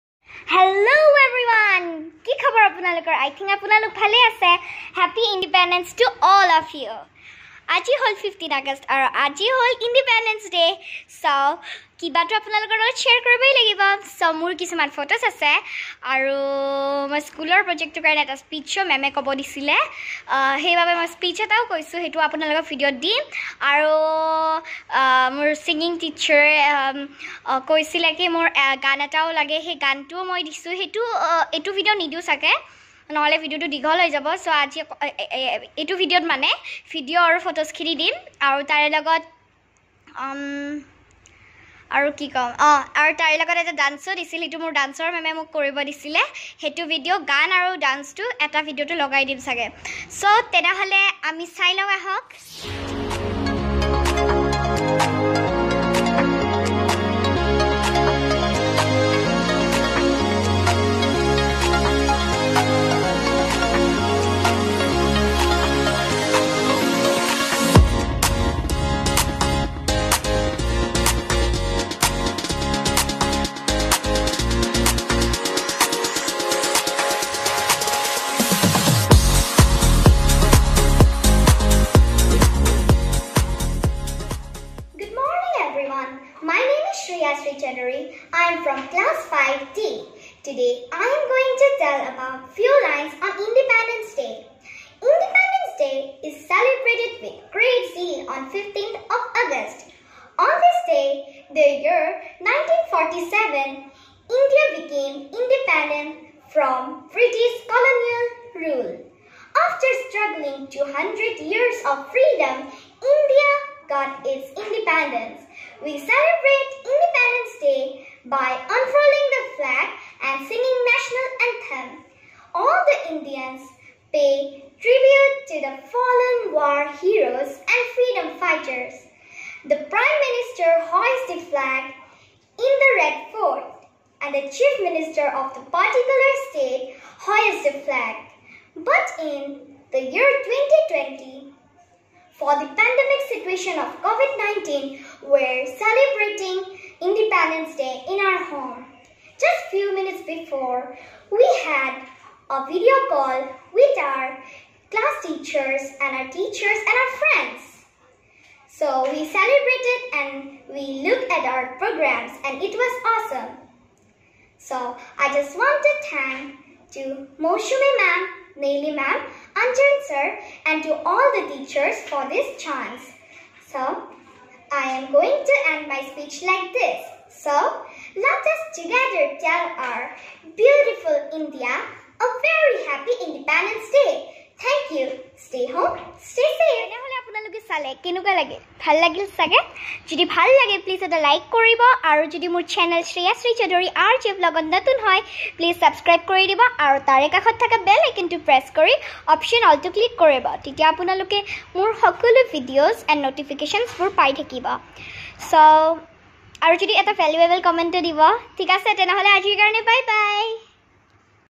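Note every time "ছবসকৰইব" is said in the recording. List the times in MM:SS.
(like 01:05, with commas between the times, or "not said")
03:15.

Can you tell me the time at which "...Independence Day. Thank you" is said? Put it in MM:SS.
03:03.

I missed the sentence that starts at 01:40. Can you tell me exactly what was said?
On this day, the year 1947, India became independent from British colonial rule.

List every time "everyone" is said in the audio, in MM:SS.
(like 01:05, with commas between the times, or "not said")
00:01, 01:26.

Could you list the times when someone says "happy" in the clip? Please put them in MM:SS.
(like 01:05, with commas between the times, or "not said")
00:04, 03:02.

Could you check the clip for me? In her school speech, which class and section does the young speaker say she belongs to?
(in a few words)
5D.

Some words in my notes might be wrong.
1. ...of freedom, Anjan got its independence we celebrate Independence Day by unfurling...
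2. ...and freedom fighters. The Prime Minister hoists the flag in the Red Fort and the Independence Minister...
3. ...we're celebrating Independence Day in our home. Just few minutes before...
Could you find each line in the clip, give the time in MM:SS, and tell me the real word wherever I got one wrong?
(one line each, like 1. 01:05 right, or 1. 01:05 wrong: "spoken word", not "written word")
1. 01:51 wrong: "India", not "Anjan"
2. 02:07 wrong: "Chief", not "Independence"
3. 02:25 right.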